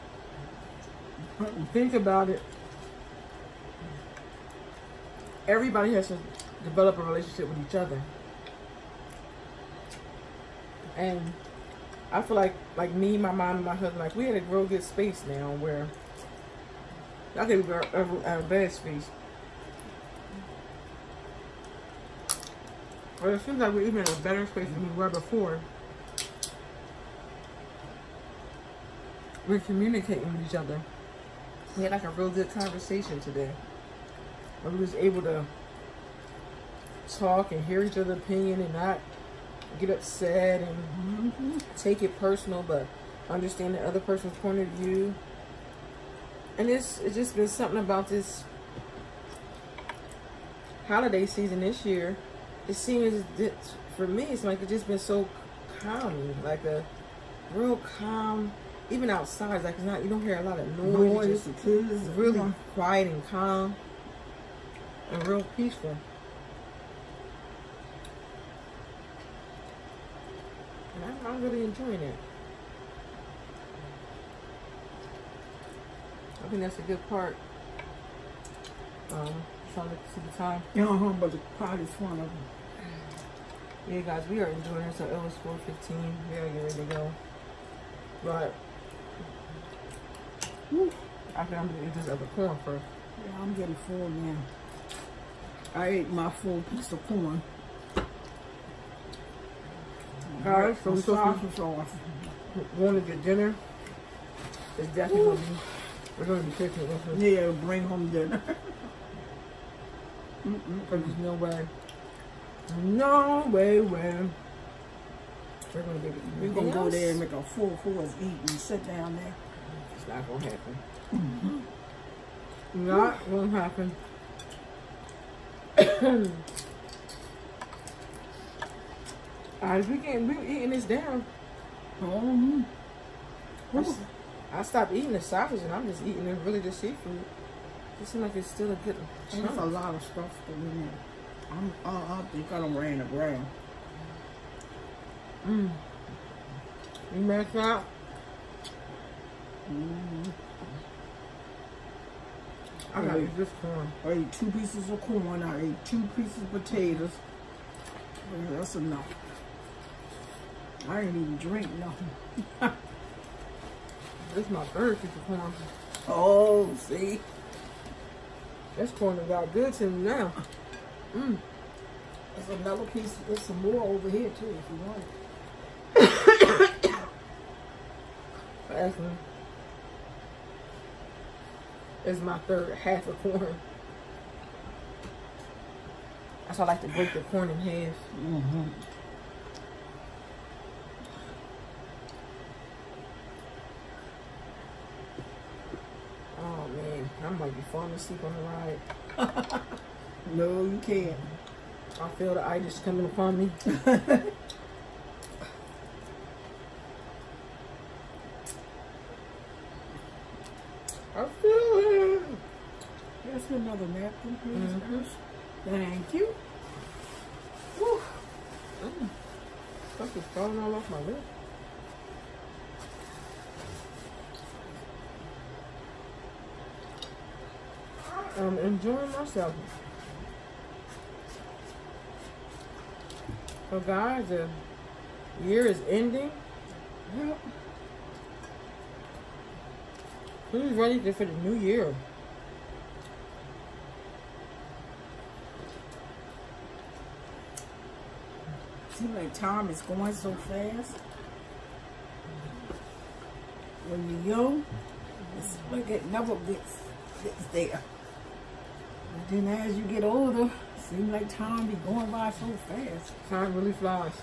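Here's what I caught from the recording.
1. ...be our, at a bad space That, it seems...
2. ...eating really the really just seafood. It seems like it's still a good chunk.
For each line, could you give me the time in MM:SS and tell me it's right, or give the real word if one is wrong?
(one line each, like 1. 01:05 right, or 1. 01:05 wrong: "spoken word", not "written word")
1. 00:17 wrong: "Well", not "That"
2. 02:16 right.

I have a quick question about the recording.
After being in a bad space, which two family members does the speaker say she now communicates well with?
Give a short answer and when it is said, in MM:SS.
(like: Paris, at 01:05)
my mom and my husband, at 00:13.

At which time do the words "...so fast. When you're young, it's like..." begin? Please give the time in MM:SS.
04:10.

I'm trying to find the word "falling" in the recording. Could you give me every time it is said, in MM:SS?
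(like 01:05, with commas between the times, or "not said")
03:17, 03:40.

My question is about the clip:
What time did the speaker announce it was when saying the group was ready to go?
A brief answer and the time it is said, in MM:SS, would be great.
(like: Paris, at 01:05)
4:15, at 01:25.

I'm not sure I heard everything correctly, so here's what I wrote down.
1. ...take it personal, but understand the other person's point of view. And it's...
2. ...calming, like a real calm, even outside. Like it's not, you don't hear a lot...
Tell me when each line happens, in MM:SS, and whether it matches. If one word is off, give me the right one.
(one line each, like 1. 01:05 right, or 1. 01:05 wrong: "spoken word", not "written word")
1. 00:41 right
2. 00:55 right.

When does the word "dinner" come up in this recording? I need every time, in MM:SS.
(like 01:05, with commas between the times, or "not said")
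01:43, 01:48.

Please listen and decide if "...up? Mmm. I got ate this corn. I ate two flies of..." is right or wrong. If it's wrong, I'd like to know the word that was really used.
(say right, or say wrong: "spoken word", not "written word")
wrong: "pieces", not "flies".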